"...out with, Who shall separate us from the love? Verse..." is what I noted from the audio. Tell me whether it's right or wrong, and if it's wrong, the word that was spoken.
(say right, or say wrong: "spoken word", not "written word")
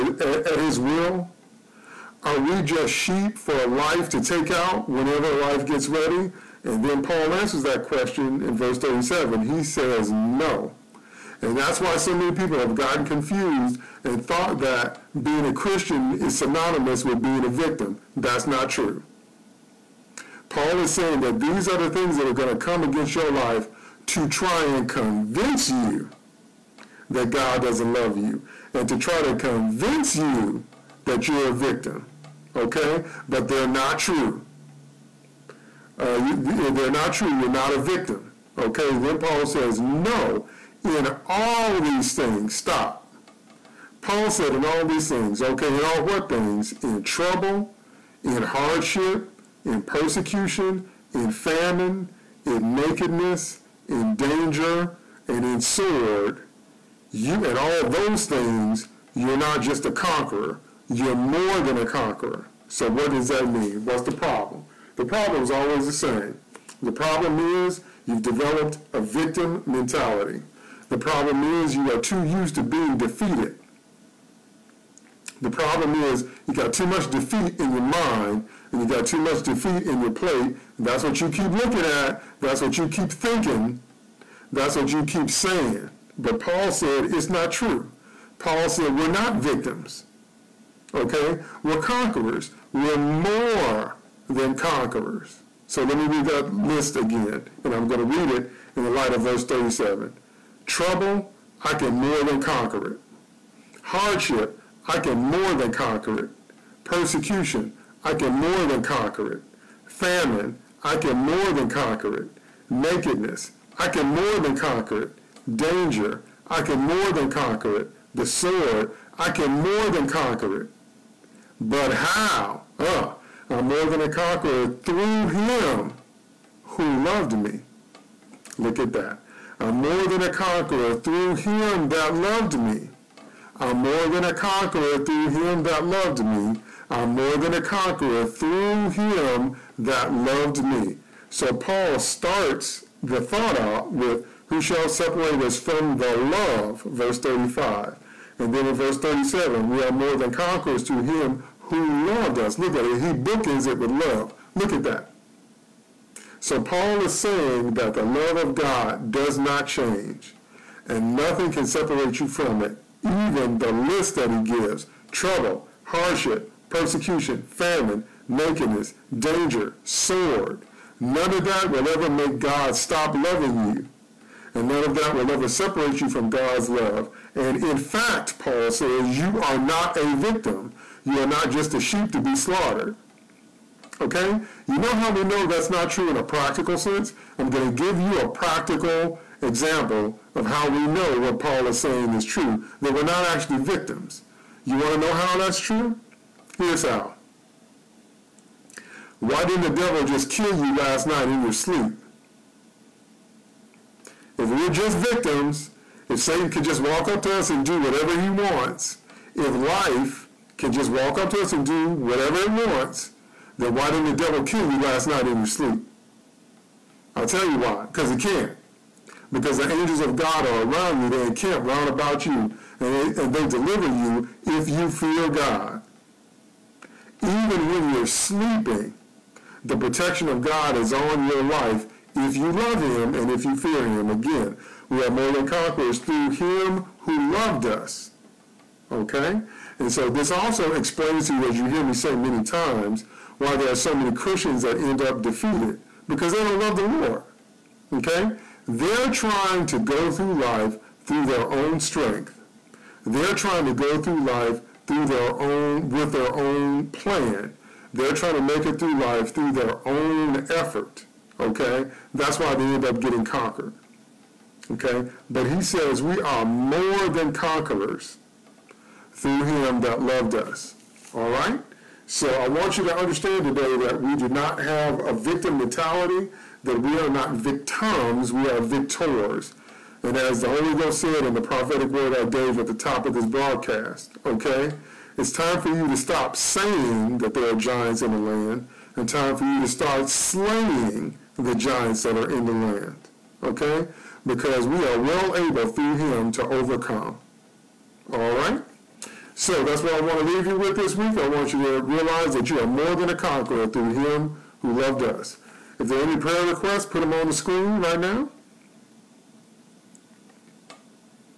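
right.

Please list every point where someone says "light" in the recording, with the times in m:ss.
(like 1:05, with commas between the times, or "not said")
1:38.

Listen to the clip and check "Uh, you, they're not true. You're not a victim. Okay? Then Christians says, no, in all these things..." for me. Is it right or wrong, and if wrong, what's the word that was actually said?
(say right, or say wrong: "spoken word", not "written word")
wrong: "Paul", not "Christians".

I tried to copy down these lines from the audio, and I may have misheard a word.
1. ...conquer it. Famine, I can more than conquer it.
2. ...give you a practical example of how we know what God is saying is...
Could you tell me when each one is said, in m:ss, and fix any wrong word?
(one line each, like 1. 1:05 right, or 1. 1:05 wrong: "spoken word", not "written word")
1. 1:48 right
2. 3:07 wrong: "Paul", not "God".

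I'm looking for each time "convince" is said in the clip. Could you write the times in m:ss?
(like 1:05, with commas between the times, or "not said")
0:24, 0:29.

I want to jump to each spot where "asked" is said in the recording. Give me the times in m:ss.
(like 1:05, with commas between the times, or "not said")
not said.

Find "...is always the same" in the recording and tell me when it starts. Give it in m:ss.
1:05.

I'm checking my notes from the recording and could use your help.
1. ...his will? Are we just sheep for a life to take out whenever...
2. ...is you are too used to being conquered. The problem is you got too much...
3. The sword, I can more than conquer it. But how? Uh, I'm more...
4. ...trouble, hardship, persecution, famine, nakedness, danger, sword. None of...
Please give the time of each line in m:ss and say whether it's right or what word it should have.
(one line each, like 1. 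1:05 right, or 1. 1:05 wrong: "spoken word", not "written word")
1. 0:00 right
2. 1:11 wrong: "defeated", not "conquered"
3. 1:58 right
4. 2:45 right.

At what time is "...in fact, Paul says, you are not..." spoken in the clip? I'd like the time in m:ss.
2:57.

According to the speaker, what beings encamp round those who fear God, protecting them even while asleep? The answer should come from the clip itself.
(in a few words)
Angels of God.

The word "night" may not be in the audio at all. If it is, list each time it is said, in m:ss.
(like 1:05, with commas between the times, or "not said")
3:21, 3:35.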